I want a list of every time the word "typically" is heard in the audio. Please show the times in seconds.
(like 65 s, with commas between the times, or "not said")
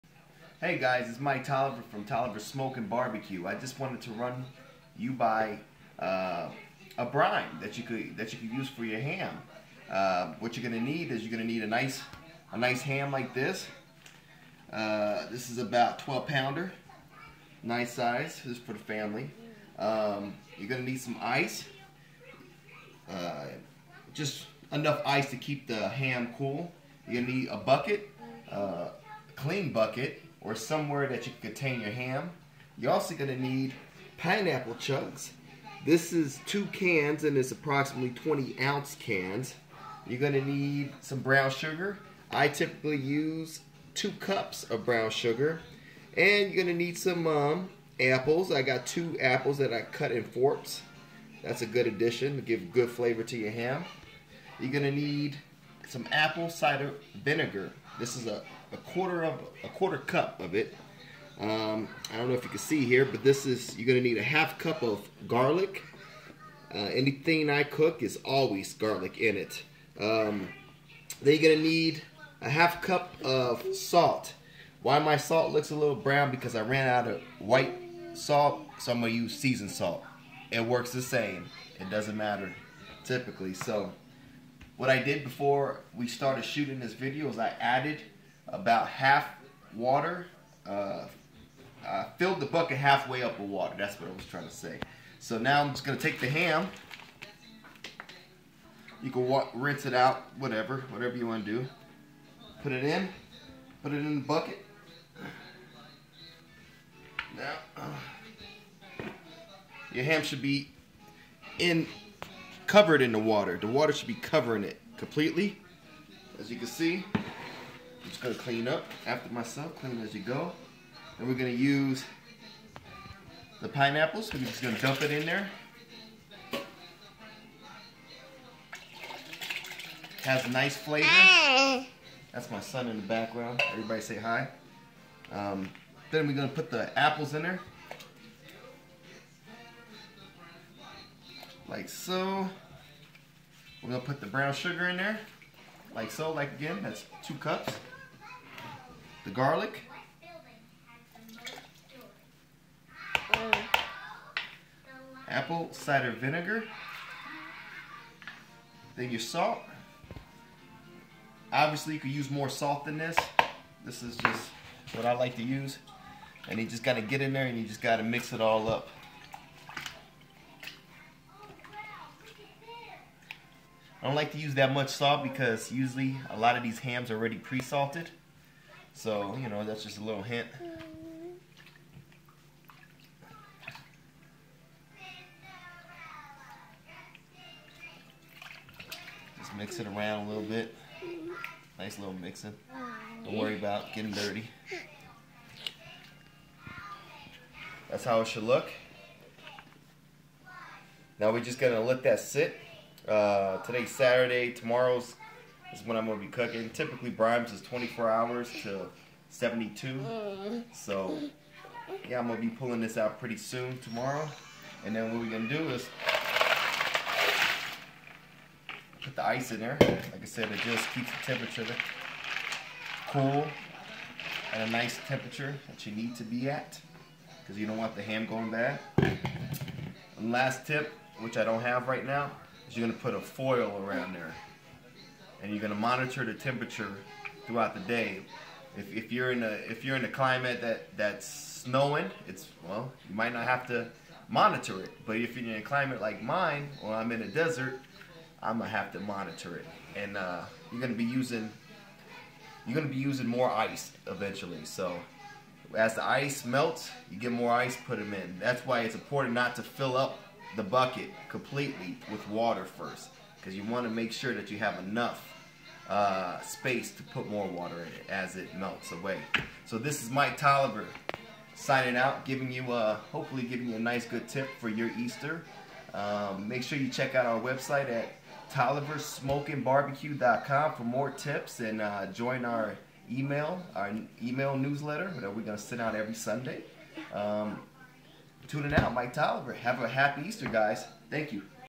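42 s, 83 s, 206 s.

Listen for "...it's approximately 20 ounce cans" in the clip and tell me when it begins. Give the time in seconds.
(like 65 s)
37 s.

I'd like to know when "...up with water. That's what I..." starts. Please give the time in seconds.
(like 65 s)
93 s.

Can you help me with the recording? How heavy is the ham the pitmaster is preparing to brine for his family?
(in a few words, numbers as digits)
12 pounds.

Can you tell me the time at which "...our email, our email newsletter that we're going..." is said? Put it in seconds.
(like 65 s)
282 s.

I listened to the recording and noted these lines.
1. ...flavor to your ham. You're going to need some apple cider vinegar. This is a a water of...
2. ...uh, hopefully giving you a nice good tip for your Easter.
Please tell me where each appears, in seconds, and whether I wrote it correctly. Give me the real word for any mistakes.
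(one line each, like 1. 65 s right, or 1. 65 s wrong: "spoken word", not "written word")
1. 52 s wrong: "quarter", not "water"
2. 272 s right.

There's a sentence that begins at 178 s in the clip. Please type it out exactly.
So, you know, that's just a little hint.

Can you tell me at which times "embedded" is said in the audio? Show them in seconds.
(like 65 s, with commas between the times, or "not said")
not said.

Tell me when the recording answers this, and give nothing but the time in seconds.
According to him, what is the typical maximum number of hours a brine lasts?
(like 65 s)
209 s.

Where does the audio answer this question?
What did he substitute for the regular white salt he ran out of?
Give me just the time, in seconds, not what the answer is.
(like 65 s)
79 s.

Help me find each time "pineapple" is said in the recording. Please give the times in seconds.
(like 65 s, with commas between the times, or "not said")
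34 s, 123 s.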